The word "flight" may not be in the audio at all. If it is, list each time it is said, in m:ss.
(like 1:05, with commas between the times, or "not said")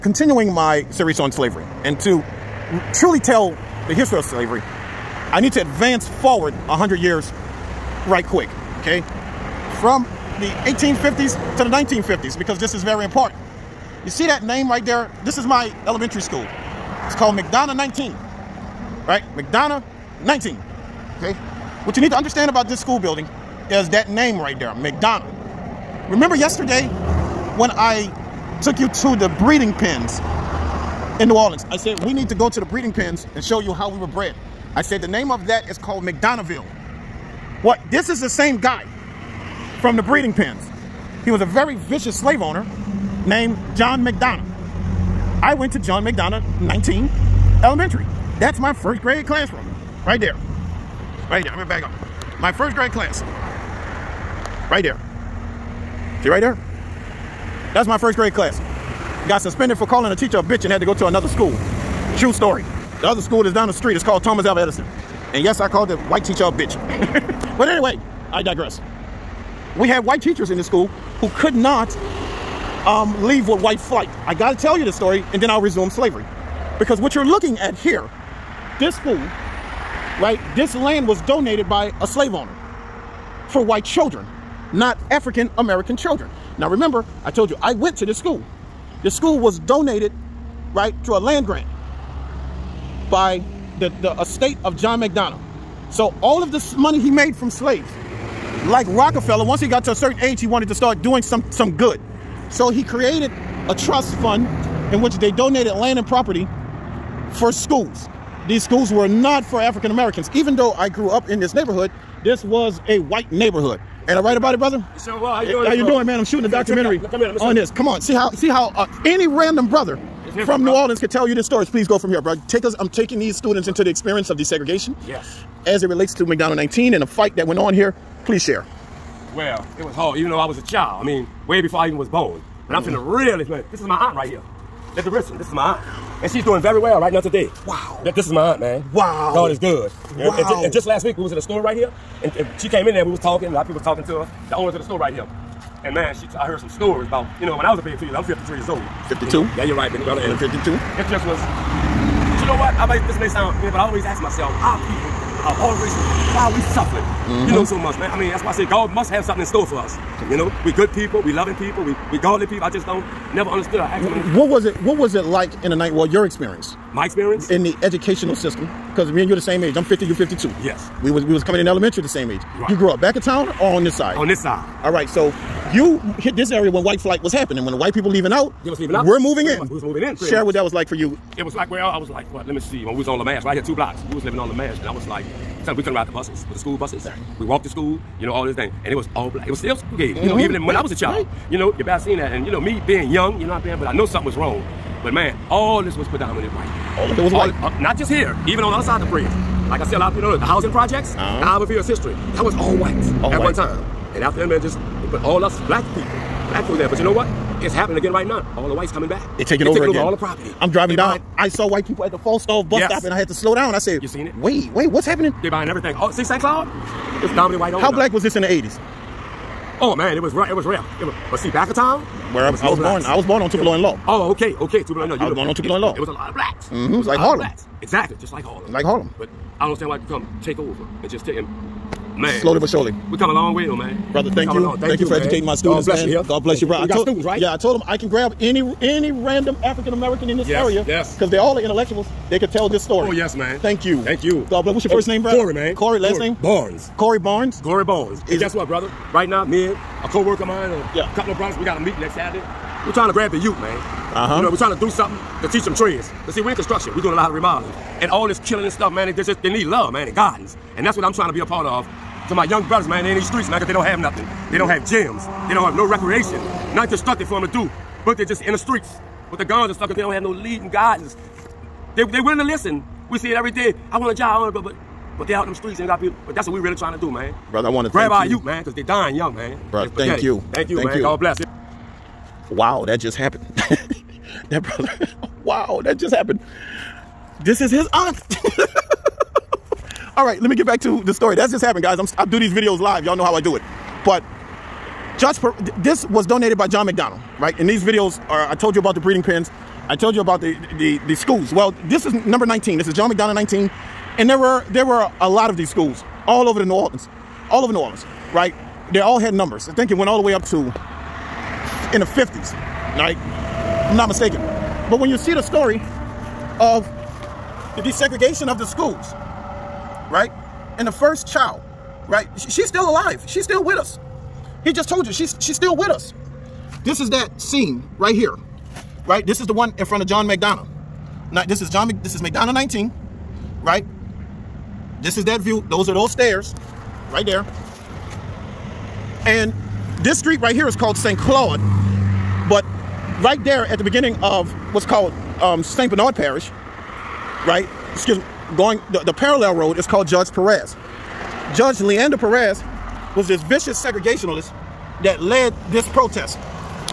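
1:13, 2:56.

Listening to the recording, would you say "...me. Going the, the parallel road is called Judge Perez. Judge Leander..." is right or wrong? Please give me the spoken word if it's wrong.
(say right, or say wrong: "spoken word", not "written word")
right.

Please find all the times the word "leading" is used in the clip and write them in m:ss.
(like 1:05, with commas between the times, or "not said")
4:30.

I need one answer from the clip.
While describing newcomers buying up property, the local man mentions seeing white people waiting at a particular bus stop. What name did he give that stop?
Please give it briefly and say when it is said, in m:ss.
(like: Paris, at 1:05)
Falstaff, at 3:32.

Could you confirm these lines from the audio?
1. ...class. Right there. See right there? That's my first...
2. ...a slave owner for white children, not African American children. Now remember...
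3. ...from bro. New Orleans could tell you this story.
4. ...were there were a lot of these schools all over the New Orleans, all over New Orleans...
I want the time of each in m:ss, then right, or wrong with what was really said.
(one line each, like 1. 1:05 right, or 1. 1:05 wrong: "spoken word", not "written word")
1. 0:52 right
2. 1:22 right
3. 2:00 right
4. 5:04 right.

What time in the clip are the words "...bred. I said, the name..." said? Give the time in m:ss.
0:34.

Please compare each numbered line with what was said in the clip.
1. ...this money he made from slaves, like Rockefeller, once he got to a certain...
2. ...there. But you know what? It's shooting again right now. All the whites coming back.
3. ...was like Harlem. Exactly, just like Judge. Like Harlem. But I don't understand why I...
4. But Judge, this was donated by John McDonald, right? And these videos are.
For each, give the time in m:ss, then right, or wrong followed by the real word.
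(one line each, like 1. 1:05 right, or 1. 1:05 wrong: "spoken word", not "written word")
1. 1:36 right
2. 3:26 wrong: "happening", not "shooting"
3. 3:46 wrong: "Harlem", not "Judge"
4. 4:54 right.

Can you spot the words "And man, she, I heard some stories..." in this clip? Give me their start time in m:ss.
2:25.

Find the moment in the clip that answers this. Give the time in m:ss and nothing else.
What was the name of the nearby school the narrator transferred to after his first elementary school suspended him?
1:04.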